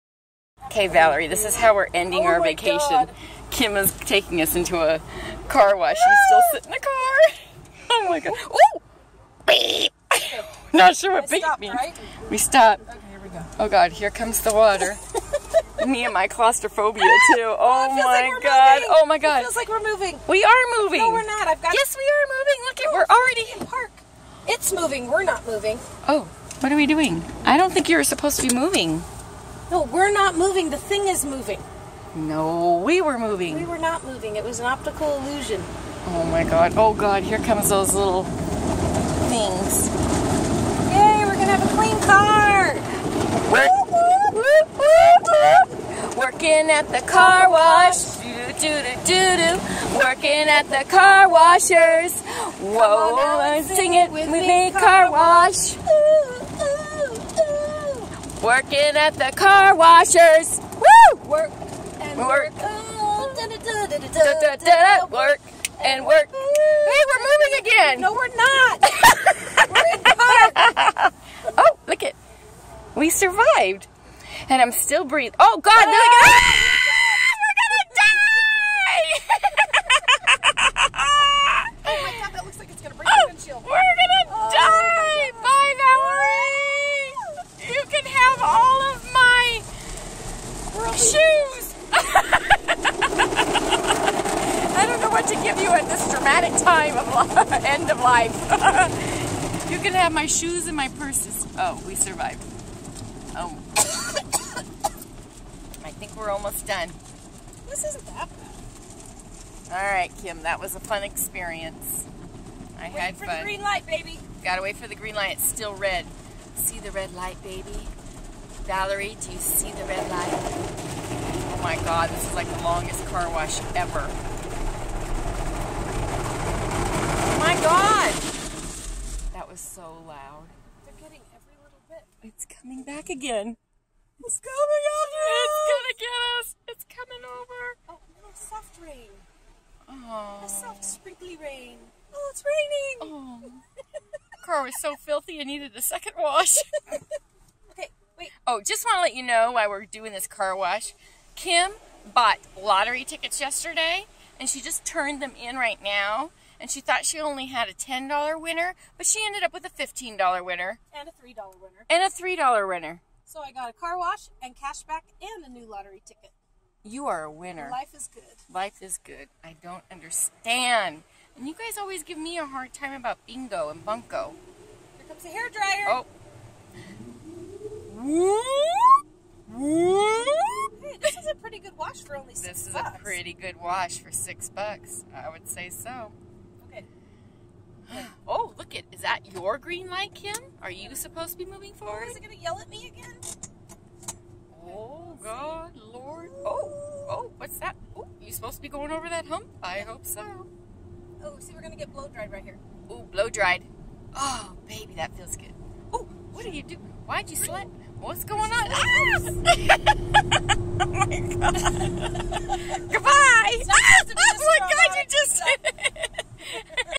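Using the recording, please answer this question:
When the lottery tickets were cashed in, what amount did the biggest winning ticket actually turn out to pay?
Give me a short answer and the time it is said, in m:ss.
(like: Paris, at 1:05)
$15, at 2:39.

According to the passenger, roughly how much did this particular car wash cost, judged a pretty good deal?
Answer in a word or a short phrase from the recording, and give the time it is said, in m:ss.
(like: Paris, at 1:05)
6 bucks, at 3:04.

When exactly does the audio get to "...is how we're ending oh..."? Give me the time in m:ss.
0:01.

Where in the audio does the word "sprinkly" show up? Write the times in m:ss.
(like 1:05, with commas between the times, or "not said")
2:20.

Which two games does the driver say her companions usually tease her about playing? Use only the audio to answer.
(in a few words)
bingo and bunko.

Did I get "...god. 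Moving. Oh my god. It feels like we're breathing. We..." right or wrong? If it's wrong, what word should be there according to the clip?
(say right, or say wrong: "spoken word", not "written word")
wrong: "moving", not "breathing".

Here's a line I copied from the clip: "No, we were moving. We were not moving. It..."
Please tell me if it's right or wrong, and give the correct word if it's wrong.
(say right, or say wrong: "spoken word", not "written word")
right.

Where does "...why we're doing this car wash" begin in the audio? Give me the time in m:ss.
2:29.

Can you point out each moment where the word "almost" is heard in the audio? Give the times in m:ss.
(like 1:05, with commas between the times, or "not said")
1:46.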